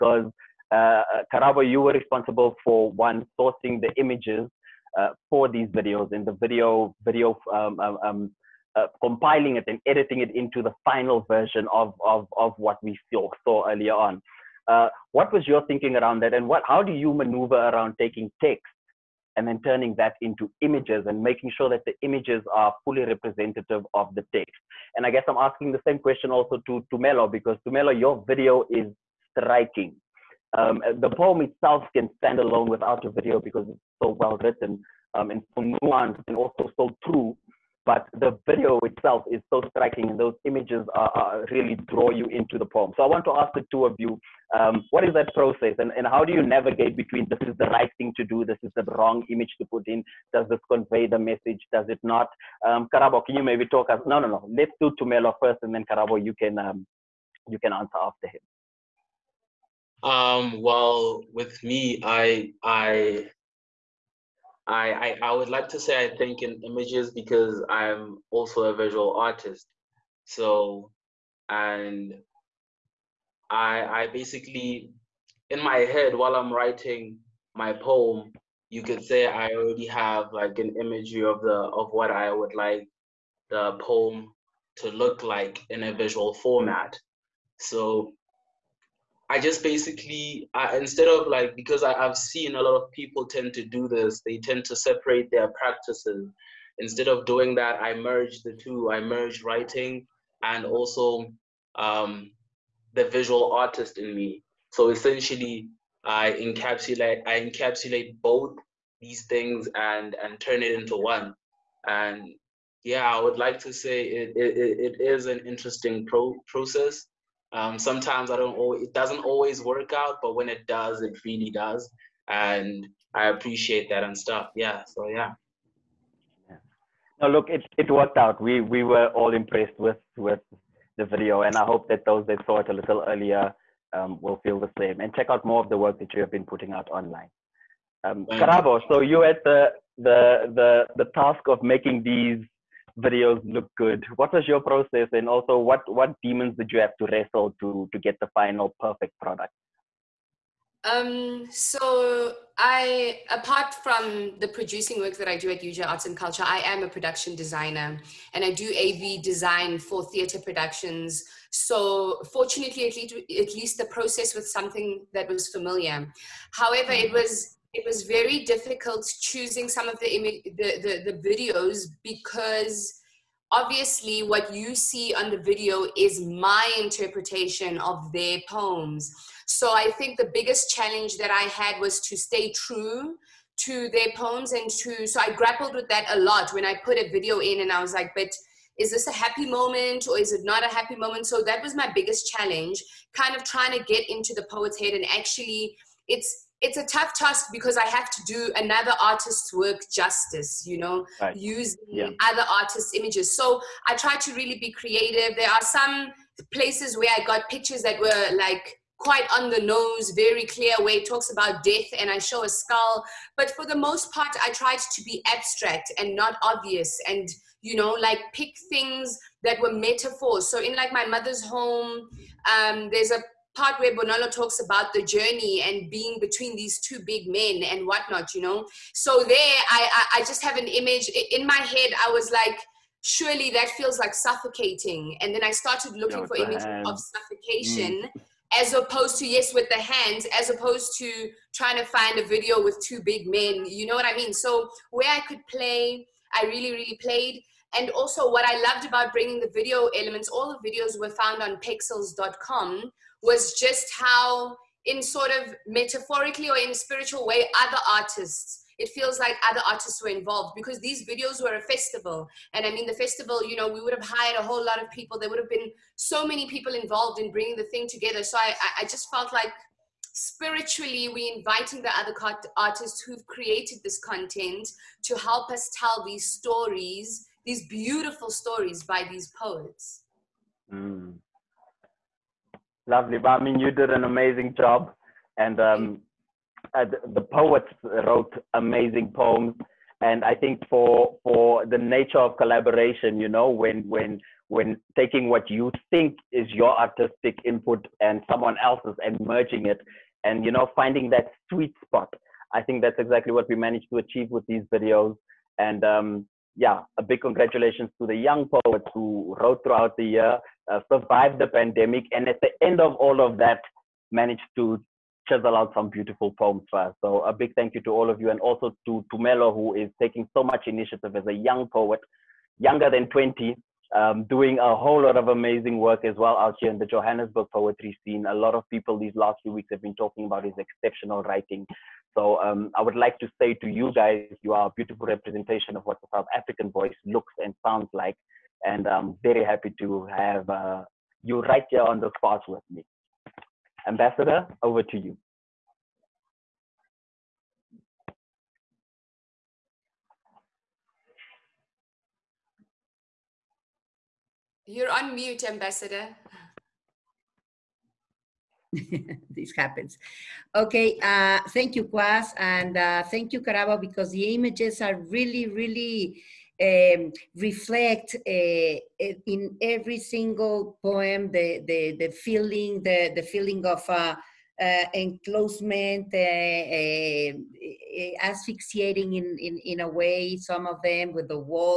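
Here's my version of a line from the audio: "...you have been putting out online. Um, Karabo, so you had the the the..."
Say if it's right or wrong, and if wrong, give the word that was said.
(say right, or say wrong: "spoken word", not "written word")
right.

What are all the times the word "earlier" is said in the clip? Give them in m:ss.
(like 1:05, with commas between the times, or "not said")
0:13, 2:13.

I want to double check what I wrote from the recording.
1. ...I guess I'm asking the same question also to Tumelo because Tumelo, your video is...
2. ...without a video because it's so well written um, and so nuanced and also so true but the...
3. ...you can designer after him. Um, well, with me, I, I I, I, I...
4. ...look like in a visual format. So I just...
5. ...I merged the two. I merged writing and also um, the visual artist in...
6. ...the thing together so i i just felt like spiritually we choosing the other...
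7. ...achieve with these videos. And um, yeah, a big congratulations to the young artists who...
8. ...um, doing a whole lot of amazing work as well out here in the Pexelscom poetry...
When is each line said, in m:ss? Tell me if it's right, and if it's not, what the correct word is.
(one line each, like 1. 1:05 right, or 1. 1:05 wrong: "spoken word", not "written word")
1. 0:25 right
2. 0:32 right
3. 0:57 wrong: "answer", not "designer"
4. 1:24 right
5. 1:37 right
6. 4:27 wrong: "inviting", not "choosing"
7. 5:03 wrong: "poets", not "artists"
8. 5:23 wrong: "Johannesburg", not "Pexelscom".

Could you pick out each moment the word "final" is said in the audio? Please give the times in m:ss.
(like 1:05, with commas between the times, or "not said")
0:10, 2:28.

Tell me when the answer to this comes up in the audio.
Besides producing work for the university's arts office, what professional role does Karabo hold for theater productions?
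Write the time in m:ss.
2:36.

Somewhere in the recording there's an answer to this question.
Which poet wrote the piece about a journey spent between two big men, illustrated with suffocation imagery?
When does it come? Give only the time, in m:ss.
3:43.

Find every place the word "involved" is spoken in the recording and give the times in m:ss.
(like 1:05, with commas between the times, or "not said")
4:20, 4:26.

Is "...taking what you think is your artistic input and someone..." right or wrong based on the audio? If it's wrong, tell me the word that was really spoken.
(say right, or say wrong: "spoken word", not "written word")
right.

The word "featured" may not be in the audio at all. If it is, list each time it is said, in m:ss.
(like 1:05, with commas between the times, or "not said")
not said.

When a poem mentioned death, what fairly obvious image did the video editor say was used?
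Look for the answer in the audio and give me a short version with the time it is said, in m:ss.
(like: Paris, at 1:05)
A skull, at 3:32.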